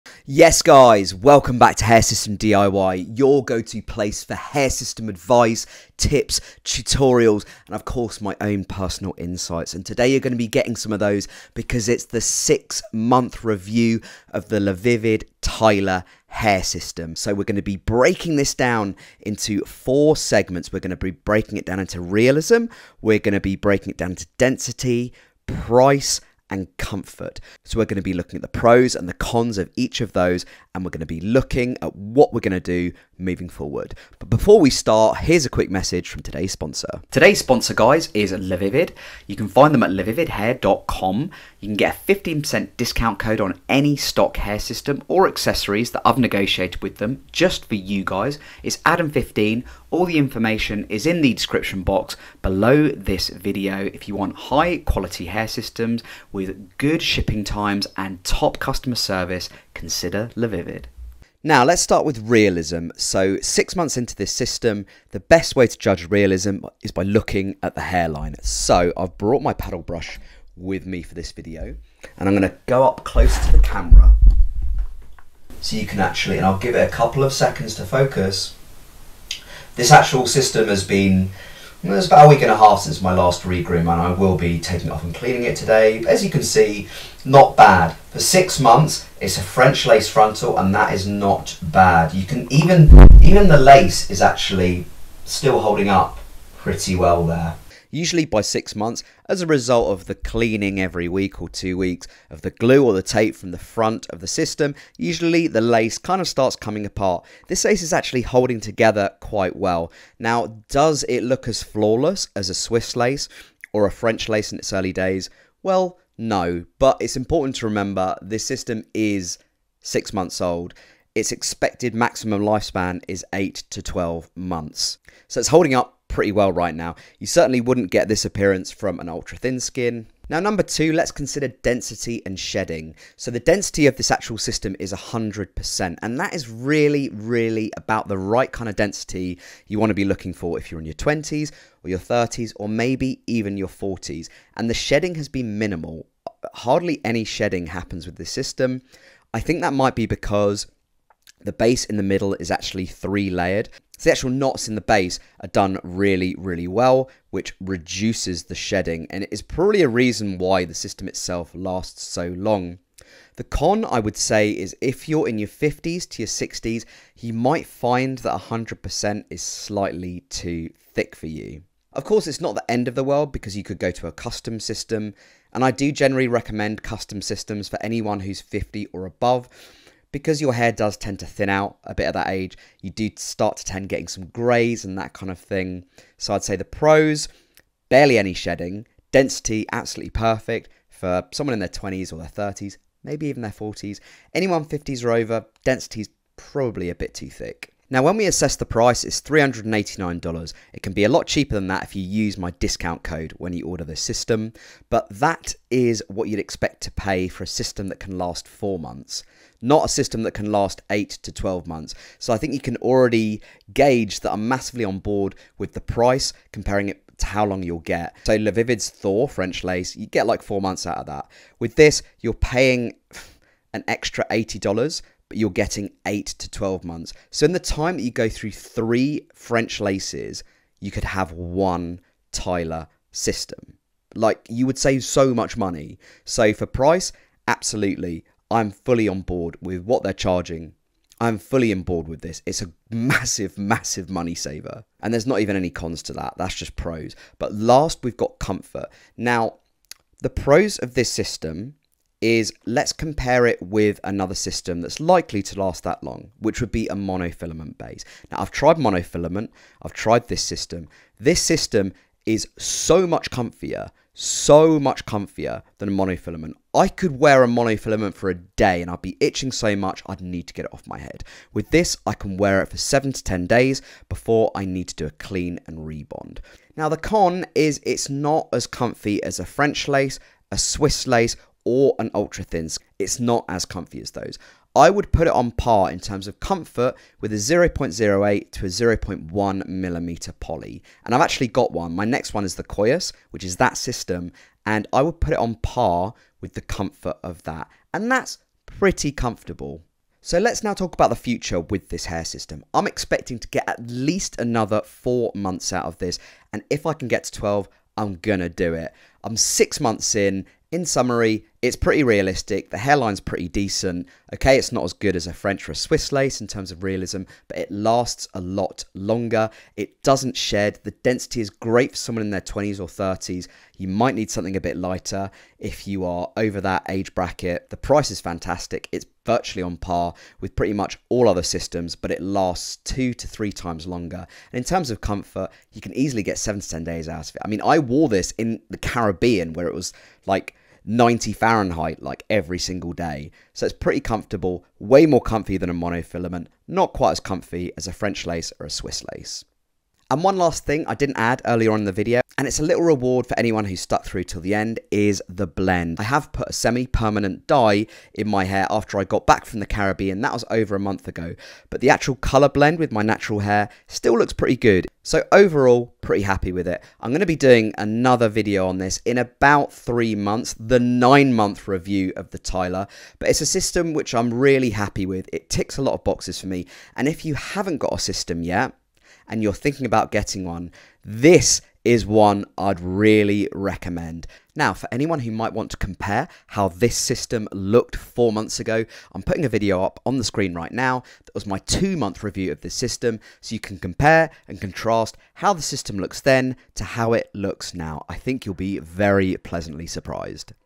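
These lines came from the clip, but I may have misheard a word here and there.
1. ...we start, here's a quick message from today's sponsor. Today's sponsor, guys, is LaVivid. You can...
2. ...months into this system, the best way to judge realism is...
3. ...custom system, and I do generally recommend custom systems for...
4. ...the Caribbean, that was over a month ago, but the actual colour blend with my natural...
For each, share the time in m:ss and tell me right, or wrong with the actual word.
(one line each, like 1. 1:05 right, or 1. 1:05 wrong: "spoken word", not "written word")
1. 0:34 right
2. 1:03 right
3. 2:54 right
4. 5:59 right.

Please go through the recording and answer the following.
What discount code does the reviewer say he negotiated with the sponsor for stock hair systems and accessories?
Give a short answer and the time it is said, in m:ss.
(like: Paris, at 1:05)
Adam15, at 0:48.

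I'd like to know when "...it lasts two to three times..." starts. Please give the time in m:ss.
5:32.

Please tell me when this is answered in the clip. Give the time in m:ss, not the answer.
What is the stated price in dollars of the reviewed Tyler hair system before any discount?
3:19.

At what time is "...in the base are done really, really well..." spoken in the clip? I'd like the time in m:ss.
2:34.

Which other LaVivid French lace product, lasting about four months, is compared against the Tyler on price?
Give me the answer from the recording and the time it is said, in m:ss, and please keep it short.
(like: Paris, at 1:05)
Thor, at 3:38.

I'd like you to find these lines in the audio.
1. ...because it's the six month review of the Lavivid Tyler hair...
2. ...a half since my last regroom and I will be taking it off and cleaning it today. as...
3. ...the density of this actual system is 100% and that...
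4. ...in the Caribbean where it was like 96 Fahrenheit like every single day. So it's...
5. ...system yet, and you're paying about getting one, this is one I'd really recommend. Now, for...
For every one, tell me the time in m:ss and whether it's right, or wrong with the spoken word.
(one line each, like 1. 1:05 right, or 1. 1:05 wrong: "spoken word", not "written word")
1. 0:11 right
2. 1:22 right
3. 2:13 right
4. 5:38 wrong: "90", not "96"
5. 6:17 wrong: "thinking", not "paying".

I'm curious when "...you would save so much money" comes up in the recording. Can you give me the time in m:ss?
3:54.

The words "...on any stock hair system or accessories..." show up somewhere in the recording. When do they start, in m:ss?
0:43.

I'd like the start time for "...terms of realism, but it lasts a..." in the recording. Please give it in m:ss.
5:16.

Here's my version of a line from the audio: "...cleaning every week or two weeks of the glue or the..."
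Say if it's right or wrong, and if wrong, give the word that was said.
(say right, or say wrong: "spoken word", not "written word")
right.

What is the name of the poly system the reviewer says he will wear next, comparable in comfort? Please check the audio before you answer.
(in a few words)
Koyus.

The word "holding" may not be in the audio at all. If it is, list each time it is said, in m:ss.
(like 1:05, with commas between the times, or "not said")
1:35, 1:48, 2:05.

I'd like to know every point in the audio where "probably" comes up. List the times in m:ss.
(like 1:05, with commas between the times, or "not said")
2:39, 3:16.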